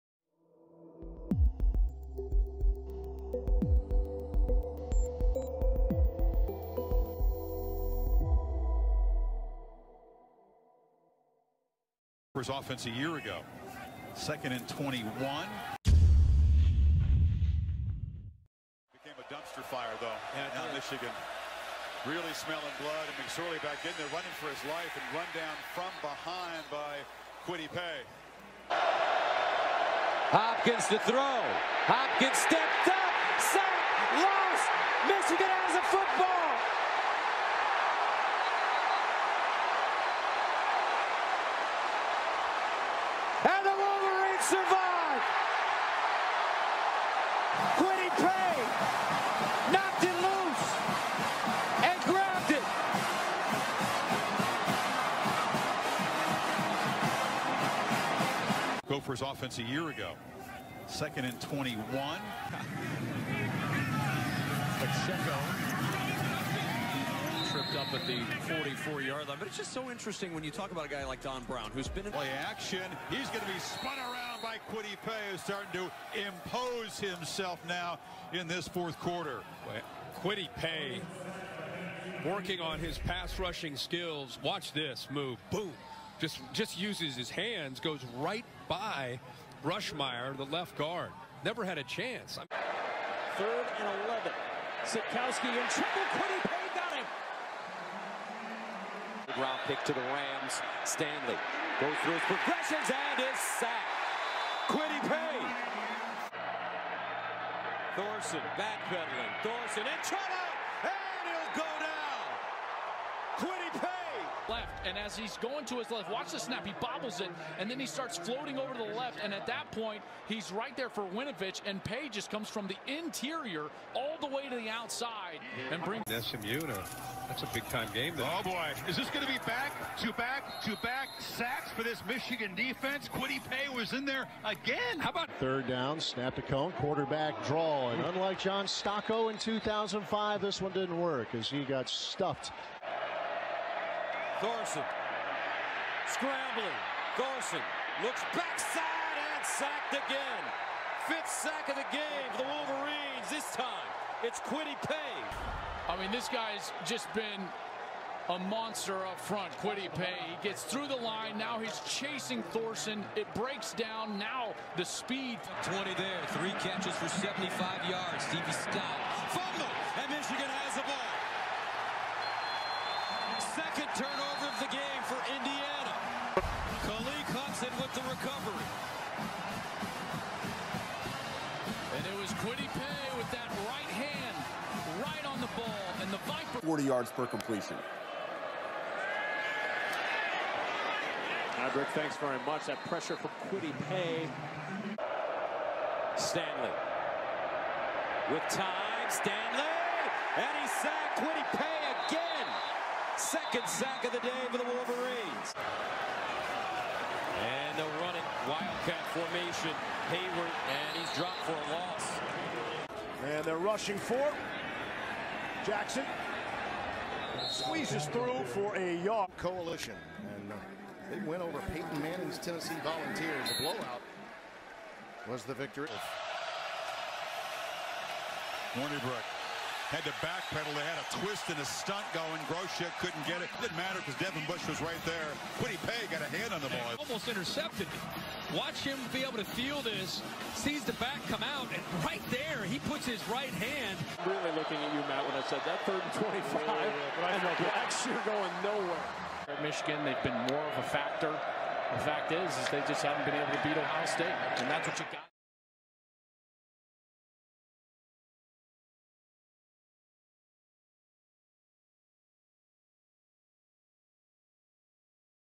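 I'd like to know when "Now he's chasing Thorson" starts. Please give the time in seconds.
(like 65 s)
161 s.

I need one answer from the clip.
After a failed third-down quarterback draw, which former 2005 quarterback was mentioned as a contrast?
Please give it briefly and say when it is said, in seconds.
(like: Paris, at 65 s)
John Stocco, at 138 s.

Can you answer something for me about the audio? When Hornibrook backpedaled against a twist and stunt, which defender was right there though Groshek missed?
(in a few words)
Devin Bush.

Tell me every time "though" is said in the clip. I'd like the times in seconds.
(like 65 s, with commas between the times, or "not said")
19 s, 128 s.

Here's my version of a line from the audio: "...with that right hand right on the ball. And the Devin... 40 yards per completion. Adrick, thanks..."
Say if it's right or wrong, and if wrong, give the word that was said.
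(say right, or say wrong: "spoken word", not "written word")
wrong: "Viper", not "Devin".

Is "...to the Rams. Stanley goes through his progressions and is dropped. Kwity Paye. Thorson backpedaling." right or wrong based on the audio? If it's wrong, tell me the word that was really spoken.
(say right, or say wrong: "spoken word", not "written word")
wrong: "sacked", not "dropped".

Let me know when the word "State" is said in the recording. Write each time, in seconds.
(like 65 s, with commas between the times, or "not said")
254 s.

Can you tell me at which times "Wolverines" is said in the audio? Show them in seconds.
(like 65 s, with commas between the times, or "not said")
152 s, 204 s.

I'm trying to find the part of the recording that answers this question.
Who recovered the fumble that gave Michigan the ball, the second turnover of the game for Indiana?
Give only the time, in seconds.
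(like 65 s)
176 s.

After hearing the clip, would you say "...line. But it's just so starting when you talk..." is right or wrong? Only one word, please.
wrong.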